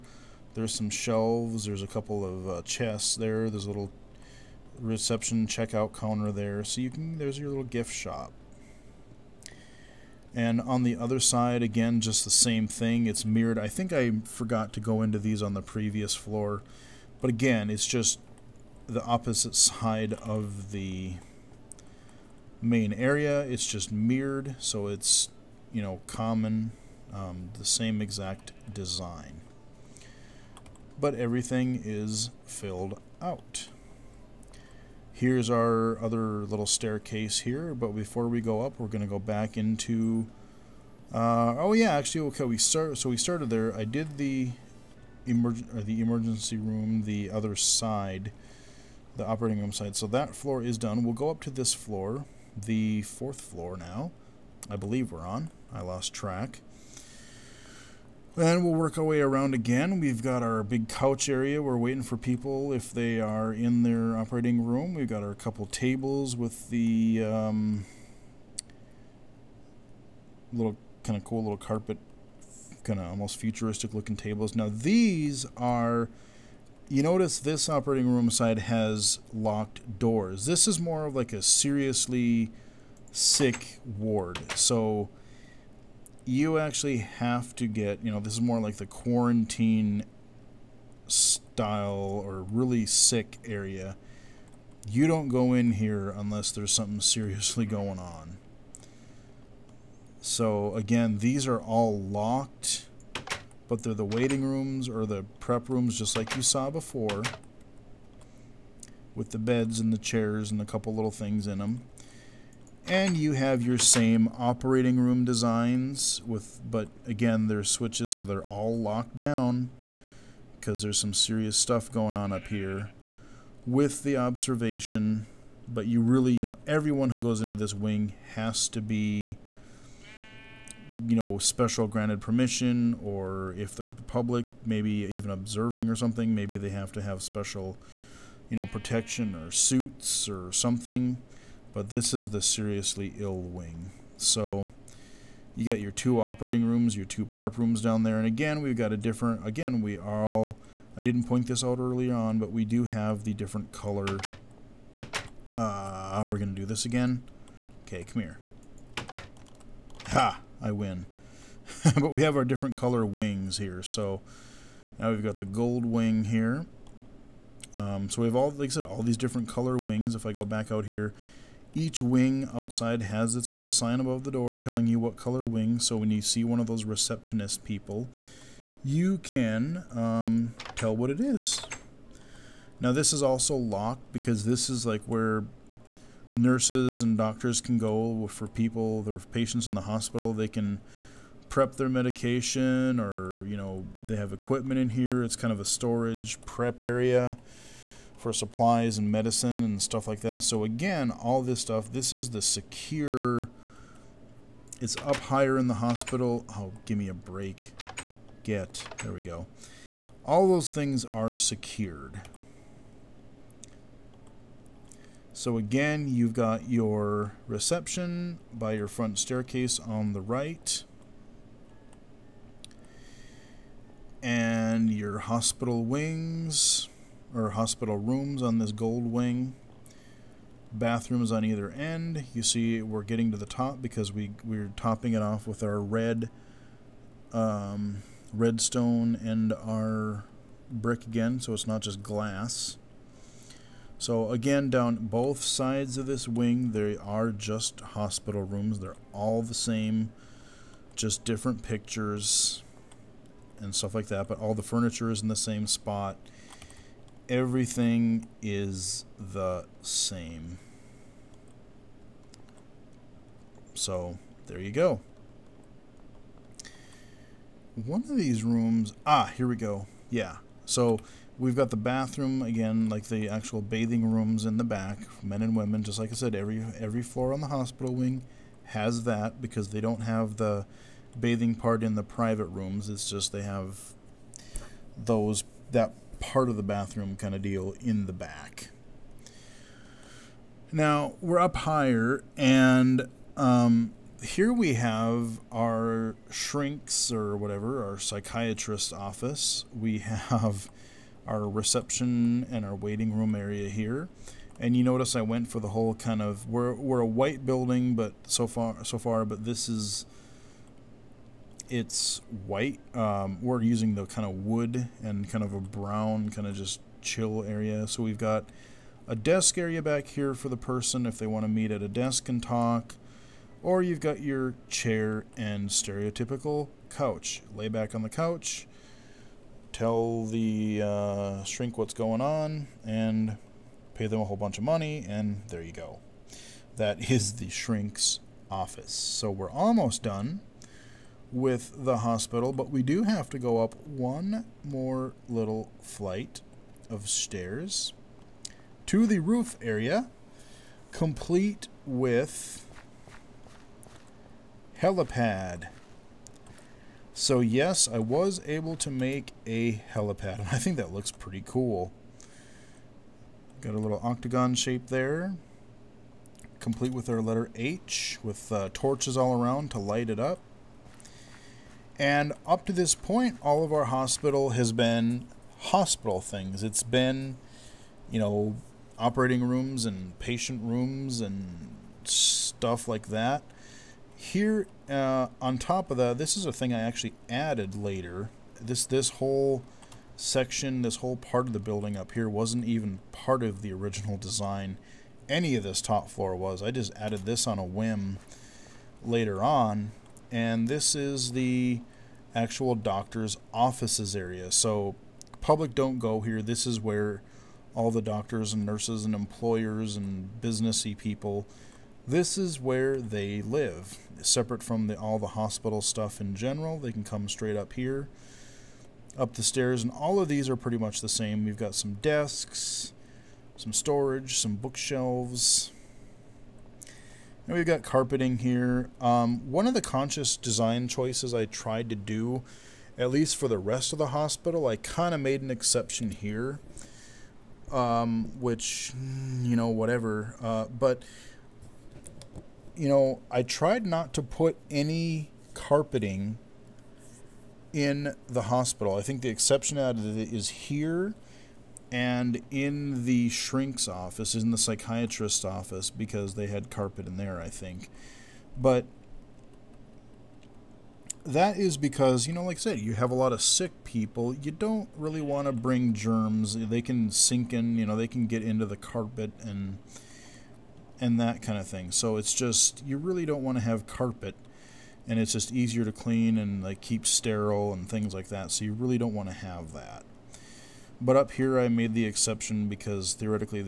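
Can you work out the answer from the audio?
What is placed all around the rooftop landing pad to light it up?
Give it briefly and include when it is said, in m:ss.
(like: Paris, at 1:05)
Torches, at 6:08.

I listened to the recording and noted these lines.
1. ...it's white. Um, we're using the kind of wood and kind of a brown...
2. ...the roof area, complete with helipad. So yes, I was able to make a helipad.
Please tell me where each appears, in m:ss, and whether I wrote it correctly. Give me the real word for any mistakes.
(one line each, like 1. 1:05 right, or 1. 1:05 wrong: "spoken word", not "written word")
1. 5:11 right
2. 5:49 right.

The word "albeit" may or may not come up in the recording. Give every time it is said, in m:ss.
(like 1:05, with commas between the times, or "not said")
not said.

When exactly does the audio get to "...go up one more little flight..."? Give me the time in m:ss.
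5:43.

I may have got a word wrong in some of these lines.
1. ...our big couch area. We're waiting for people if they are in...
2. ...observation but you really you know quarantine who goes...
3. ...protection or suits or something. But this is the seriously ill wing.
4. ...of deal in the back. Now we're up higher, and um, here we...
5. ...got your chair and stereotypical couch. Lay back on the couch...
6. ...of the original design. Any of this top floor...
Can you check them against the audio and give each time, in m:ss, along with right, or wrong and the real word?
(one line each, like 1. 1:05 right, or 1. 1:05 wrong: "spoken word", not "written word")
1. 1:00 right
2. 2:04 wrong: "everyone", not "quarantine"
3. 2:18 right
4. 4:47 right
5. 5:24 right
6. 6:33 right.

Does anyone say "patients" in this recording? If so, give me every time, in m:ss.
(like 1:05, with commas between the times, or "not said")
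3:09, 6:20.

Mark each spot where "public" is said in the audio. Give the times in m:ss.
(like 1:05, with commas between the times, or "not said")
2:13, 6:45.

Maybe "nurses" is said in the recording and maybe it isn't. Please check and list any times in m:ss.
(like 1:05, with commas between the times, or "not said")
3:06, 6:48.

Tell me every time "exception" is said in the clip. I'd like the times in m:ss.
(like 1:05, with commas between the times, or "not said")
7:15, 7:29, 8:02.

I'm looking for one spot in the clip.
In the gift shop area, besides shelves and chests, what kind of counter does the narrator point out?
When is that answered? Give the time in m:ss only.
0:04.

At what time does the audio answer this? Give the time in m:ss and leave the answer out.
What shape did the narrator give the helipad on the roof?
6:04.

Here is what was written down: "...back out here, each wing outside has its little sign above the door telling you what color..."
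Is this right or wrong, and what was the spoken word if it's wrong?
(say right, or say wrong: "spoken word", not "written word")
right.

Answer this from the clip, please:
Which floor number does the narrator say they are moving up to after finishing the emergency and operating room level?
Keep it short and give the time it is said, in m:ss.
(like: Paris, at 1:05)
Fourth floor, at 0:52.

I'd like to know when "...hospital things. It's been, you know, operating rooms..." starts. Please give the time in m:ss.
6:15.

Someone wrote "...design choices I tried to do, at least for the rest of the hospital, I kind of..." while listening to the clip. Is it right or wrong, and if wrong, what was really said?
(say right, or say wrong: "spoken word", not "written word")
right.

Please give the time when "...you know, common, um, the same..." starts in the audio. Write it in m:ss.
0:25.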